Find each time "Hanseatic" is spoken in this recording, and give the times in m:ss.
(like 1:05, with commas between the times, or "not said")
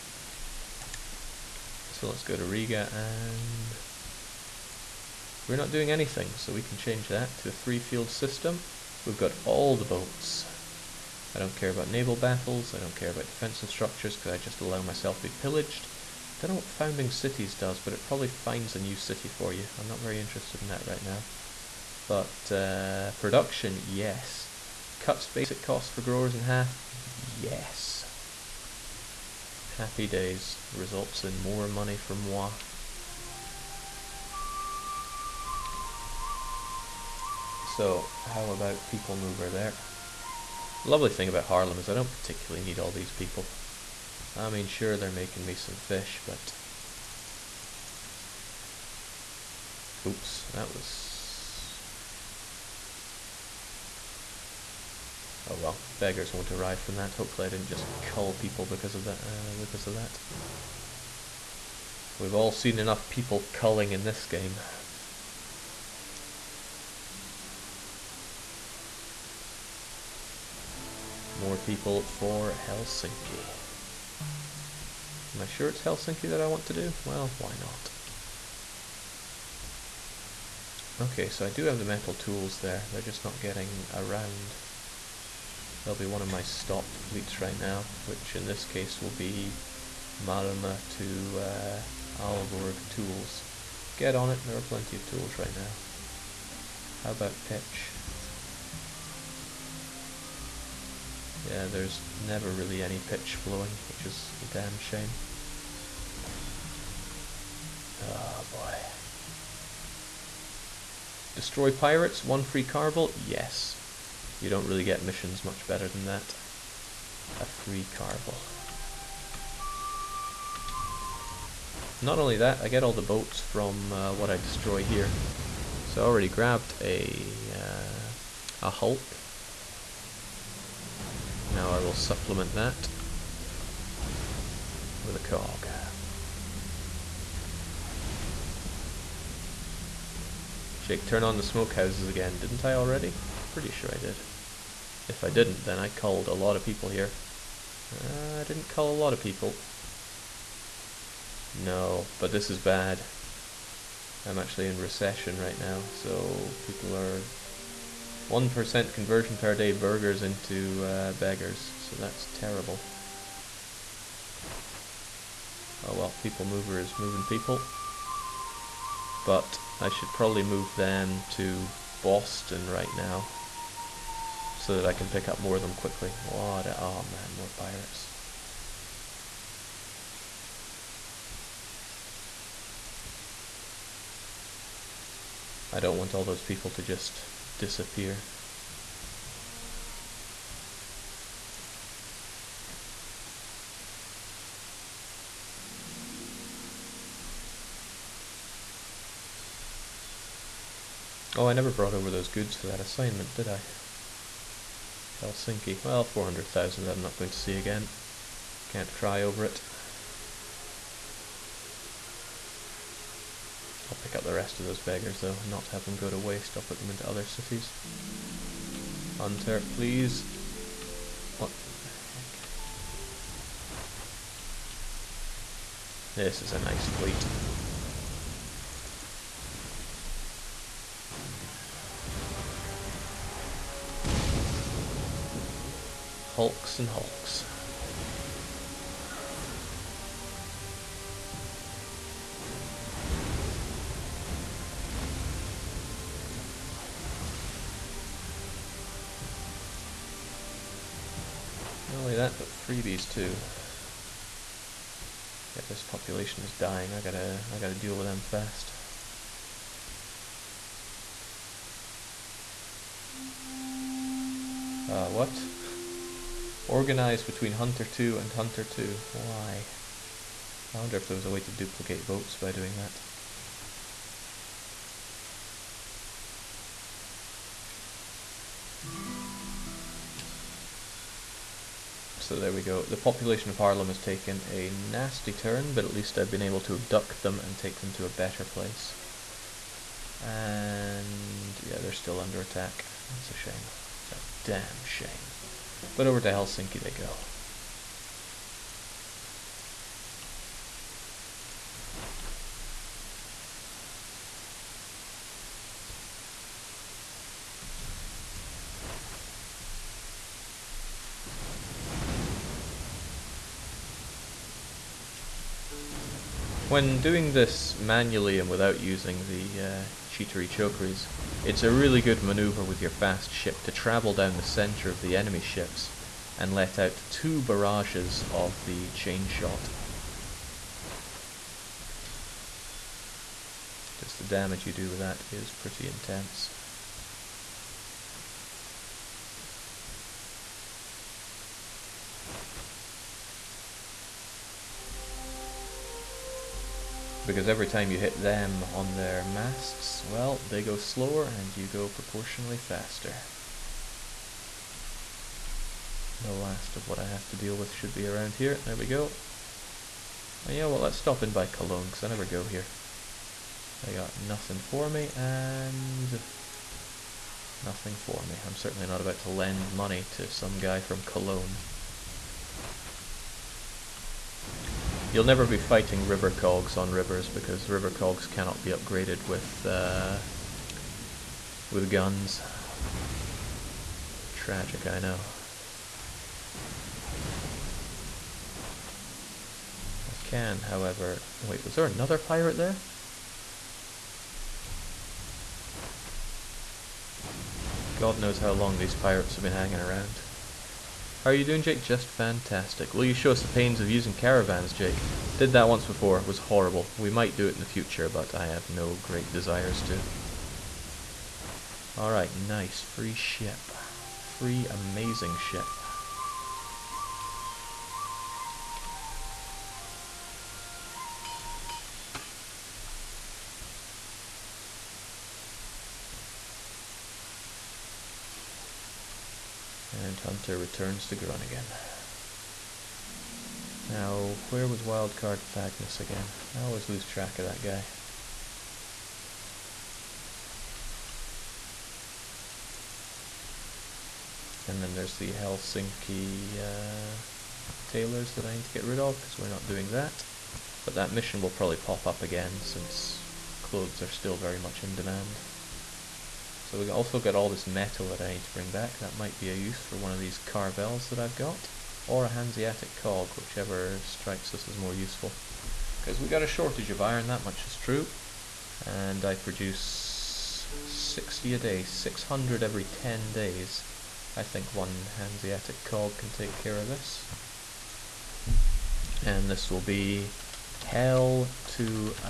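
7:42, 7:55.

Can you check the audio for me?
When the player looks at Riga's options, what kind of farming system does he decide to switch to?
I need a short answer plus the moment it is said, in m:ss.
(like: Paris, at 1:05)
three-field system, at 0:07.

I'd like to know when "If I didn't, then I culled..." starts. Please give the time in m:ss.
2:25.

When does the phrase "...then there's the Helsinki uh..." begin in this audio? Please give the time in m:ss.
7:24.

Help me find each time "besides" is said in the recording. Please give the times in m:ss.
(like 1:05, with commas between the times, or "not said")
not said.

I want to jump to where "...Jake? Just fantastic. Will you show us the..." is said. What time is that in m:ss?
6:41.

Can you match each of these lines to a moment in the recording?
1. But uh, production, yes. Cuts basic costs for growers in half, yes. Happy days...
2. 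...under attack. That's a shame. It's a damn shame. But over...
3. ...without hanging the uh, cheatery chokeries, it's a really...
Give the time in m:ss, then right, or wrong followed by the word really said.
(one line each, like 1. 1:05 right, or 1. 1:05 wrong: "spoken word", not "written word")
1. 0:22 right
2. 4:52 right
3. 5:18 wrong: "using", not "hanging".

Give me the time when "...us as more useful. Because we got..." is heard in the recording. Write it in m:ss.
7:44.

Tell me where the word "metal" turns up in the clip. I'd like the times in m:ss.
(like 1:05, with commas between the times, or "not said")
1:21, 7:37.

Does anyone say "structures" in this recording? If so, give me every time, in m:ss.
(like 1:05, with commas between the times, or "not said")
0:13.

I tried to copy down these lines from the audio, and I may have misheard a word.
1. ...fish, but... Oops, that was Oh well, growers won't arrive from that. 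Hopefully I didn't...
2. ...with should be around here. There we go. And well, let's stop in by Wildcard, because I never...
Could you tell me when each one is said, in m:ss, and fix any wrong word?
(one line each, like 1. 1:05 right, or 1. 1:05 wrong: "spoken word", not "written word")
1. 0:45 wrong: "beggars", not "growers"
2. 5:57 wrong: "Cologne", not "Wildcard".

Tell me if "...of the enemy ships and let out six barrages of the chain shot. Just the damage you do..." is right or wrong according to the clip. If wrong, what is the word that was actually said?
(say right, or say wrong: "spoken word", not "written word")
wrong: "two", not "six".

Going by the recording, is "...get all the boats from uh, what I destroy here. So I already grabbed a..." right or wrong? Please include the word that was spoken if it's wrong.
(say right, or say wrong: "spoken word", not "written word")
right.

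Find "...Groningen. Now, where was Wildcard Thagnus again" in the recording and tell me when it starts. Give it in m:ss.
7:11.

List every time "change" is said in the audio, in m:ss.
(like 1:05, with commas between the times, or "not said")
0:06.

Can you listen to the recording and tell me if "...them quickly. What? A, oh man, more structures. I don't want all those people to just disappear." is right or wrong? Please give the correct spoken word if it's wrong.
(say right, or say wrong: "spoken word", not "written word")
wrong: "pirates", not "structures".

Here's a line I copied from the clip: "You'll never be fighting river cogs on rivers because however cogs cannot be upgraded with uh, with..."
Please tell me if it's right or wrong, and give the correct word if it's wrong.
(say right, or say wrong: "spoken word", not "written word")
wrong: "river", not "however".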